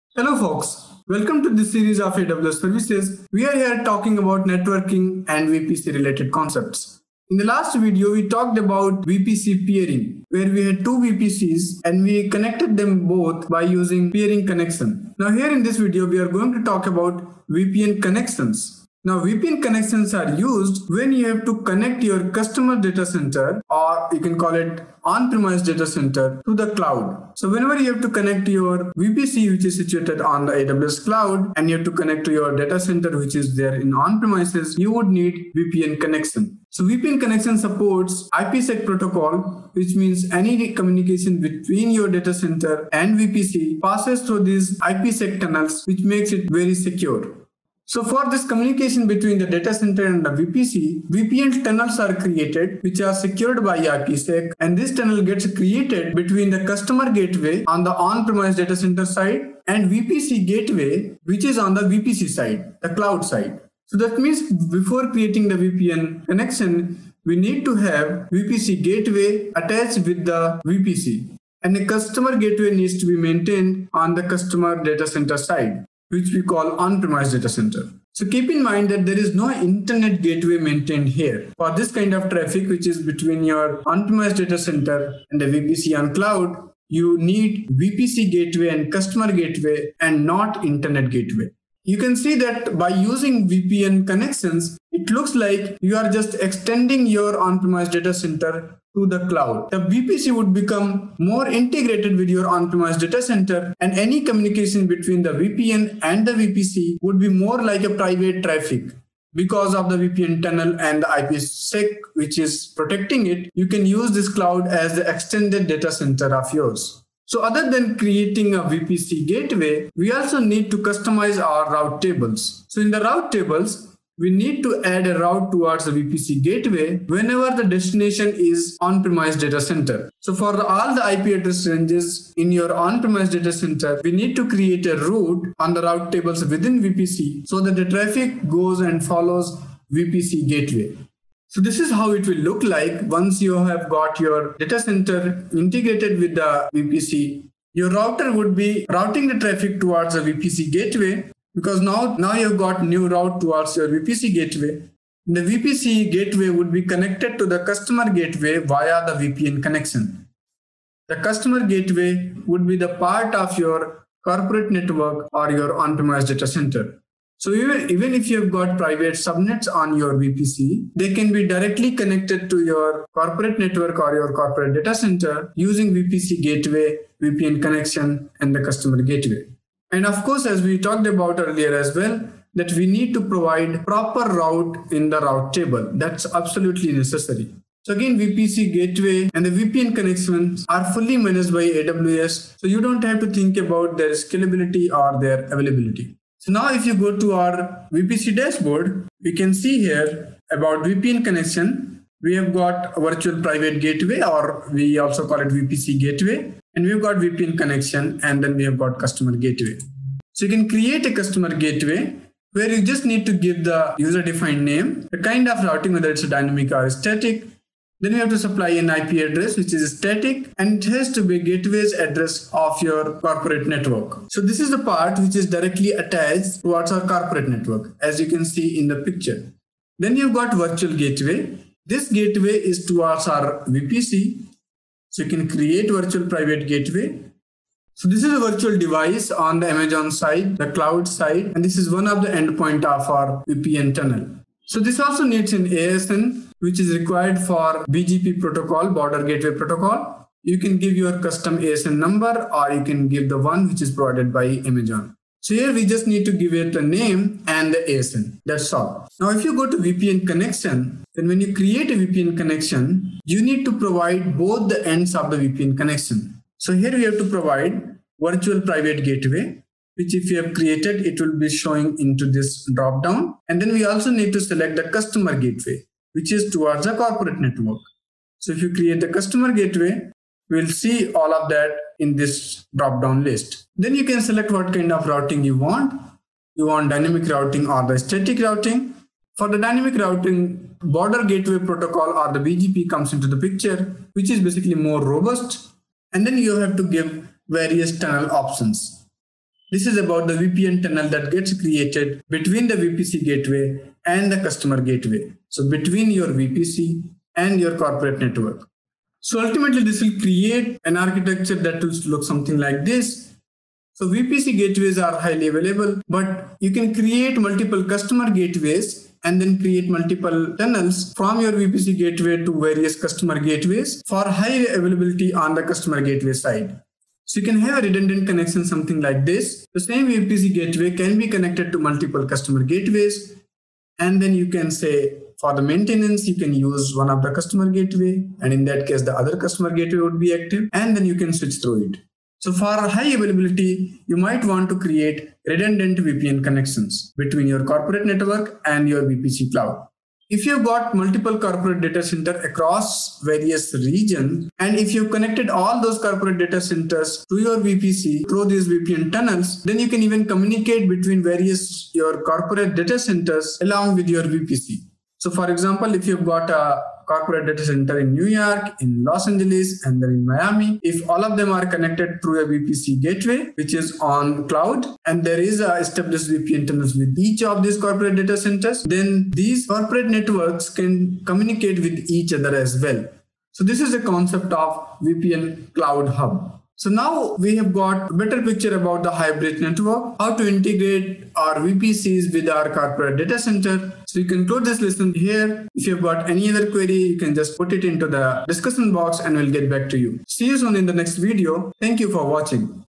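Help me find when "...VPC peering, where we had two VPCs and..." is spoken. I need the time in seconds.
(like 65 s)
9 s.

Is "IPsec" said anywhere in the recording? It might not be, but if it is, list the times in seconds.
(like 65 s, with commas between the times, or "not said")
38 s, 44 s, 53 s, 111 s.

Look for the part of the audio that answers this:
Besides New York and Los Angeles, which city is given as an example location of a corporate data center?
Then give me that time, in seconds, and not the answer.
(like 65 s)
370 s.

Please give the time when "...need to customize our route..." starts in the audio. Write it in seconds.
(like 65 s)
120 s.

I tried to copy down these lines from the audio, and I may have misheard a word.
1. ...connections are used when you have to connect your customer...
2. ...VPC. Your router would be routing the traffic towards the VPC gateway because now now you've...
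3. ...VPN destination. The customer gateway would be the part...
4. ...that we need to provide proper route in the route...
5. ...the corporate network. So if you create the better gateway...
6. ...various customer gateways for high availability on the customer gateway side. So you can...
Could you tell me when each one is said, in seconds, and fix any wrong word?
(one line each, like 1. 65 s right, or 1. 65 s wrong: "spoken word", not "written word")
1. 19 s right
2. 146 s right
3. 159 s wrong: "connection", not "destination"
4. 182 s right
5. 276 s wrong: "customer", not "better"
6. 322 s right.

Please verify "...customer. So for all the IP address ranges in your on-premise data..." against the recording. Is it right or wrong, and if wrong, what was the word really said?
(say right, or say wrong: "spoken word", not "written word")
wrong: "center", not "customer".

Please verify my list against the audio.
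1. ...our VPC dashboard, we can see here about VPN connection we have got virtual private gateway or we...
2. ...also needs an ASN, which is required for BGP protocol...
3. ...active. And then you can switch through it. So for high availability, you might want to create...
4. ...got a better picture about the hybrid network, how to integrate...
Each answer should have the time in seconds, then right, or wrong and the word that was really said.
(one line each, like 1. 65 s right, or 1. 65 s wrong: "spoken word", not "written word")
1. 197 s right
2. 245 s right
3. 340 s right
4. 387 s right.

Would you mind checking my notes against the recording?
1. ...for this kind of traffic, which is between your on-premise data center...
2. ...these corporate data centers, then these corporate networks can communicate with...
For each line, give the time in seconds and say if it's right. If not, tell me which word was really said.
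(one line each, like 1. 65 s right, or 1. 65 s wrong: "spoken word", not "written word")
1. 81 s right
2. 377 s right.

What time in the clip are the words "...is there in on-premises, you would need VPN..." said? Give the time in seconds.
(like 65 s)
33 s.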